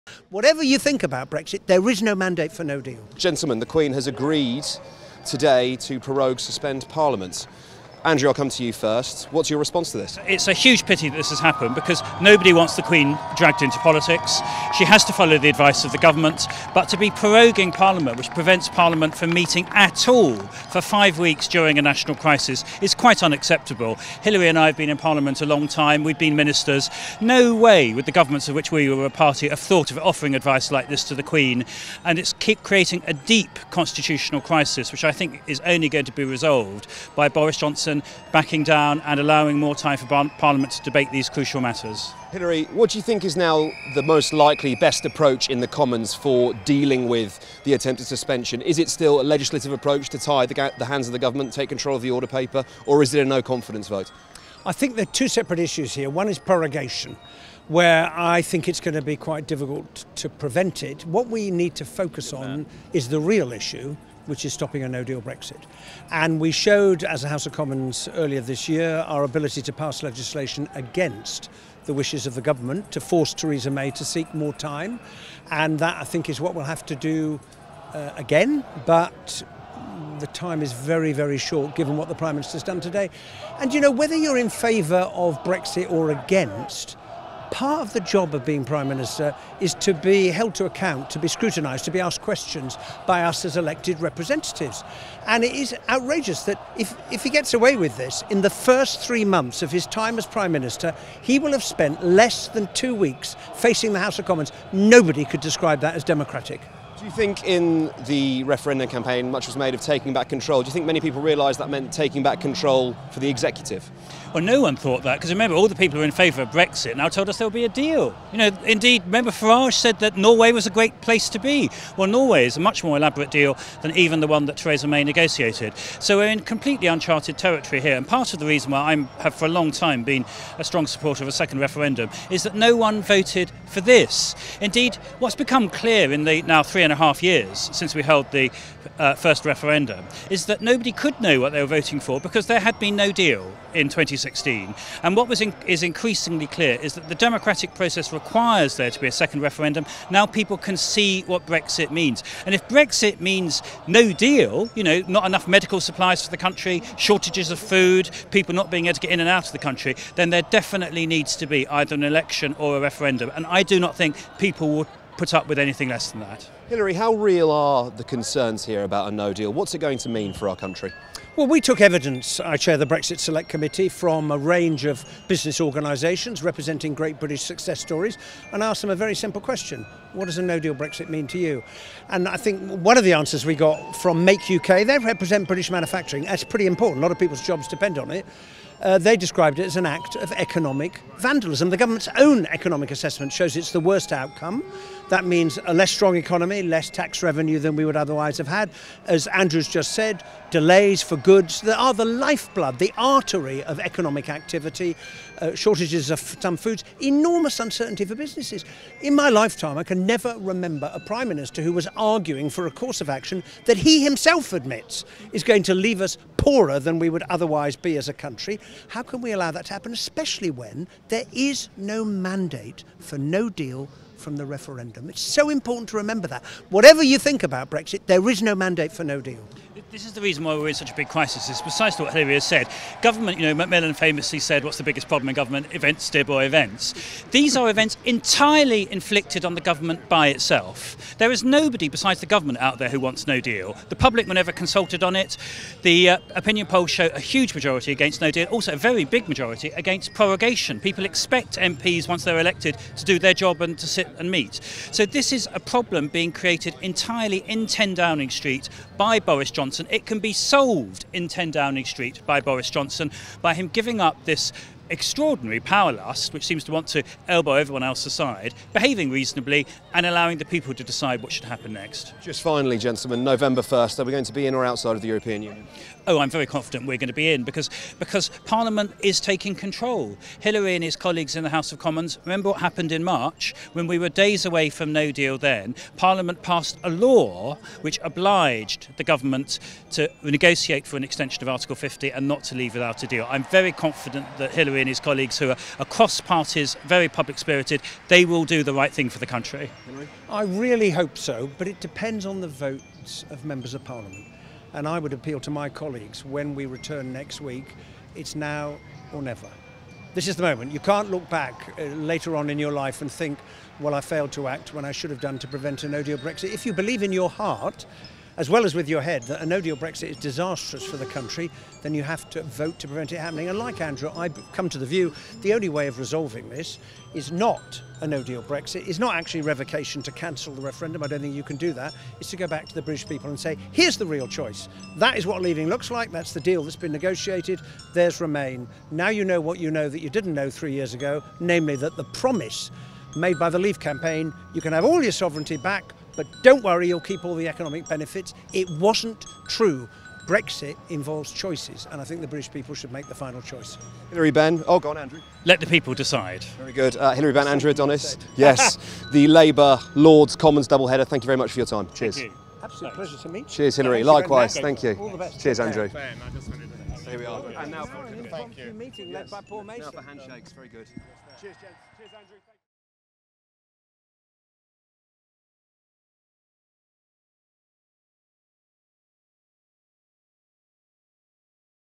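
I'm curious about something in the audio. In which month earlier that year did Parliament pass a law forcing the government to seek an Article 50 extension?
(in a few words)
March.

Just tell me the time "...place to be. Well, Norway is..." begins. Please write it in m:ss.
2:01.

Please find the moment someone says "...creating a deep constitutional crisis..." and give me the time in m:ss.
0:32.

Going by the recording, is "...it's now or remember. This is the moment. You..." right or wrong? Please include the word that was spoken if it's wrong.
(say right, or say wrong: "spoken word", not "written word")
wrong: "never", not "remember".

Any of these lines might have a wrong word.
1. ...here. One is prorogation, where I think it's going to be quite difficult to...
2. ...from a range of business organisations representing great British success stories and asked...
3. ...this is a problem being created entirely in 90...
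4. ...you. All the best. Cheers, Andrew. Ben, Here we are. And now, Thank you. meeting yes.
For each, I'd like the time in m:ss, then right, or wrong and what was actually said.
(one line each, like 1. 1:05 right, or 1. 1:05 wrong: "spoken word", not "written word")
1. 0:55 right
2. 2:53 right
3. 4:15 wrong: "10", not "90"
4. 6:04 right.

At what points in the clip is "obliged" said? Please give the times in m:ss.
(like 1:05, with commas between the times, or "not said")
4:48.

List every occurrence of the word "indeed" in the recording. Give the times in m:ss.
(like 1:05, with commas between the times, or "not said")
1:58, 2:14.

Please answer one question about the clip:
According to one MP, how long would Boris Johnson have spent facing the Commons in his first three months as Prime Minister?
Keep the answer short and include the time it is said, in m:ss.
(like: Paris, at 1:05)
less than two weeks, at 1:42.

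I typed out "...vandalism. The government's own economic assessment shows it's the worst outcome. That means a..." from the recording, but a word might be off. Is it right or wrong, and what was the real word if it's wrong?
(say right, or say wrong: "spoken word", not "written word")
right.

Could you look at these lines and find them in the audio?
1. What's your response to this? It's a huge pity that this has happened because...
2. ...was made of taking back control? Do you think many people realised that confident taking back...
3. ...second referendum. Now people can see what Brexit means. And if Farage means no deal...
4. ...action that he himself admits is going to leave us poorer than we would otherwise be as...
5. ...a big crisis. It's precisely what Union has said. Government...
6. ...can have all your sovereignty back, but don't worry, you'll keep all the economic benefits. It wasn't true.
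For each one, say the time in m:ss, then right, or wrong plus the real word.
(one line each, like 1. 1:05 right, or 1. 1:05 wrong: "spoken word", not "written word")
1. 0:09 right
2. 1:49 wrong: "meant", not "confident"
3. 2:29 wrong: "Brexit", not "Farage"
4. 3:33 right
5. 3:50 wrong: "Hilary", not "Union"
6. 5:44 right.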